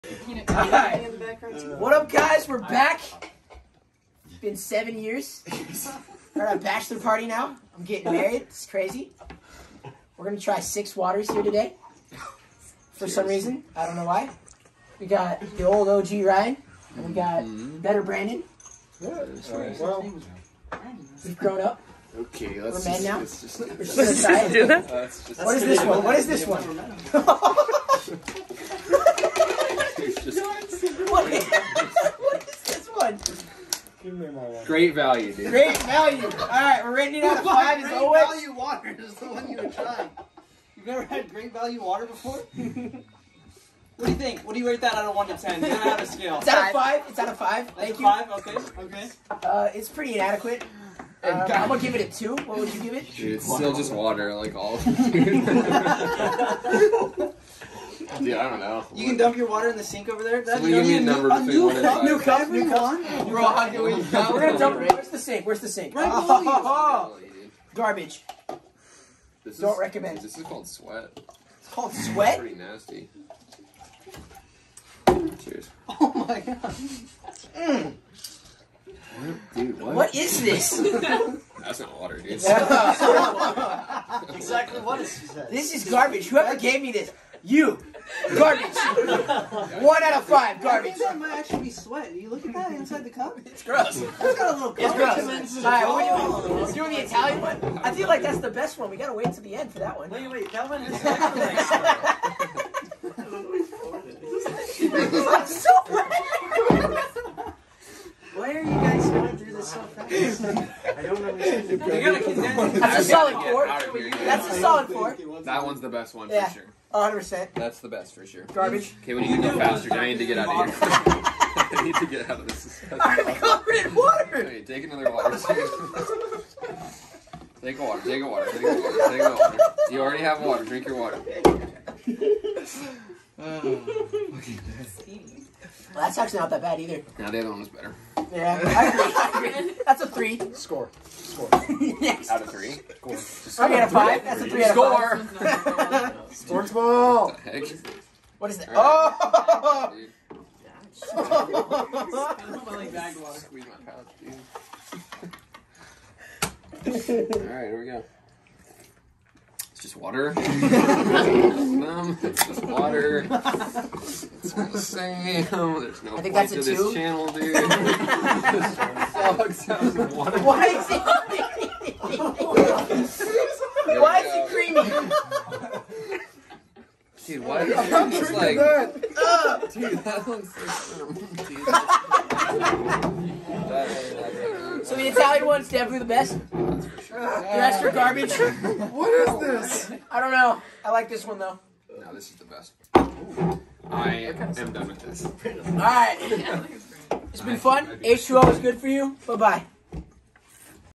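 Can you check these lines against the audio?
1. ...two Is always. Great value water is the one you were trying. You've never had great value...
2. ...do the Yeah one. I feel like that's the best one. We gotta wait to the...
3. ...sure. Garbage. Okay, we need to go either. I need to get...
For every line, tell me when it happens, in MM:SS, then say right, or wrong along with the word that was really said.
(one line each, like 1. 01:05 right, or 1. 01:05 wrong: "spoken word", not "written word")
1. 00:37 wrong: "five", not "two"
2. 01:36 wrong: "Italian", not "Yeah"
3. 01:58 wrong: "faster", not "either".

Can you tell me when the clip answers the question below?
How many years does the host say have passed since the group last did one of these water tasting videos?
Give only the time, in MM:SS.
00:04.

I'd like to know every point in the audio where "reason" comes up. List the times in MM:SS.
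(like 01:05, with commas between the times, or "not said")
00:13.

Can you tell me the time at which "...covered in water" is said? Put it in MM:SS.
02:03.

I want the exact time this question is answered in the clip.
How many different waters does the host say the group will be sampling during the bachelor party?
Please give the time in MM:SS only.
00:10.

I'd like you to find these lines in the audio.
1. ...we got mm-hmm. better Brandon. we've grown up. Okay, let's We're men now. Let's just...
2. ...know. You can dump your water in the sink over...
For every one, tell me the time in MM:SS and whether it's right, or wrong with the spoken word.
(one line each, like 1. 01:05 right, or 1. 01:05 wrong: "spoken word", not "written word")
1. 00:17 right
2. 00:58 right.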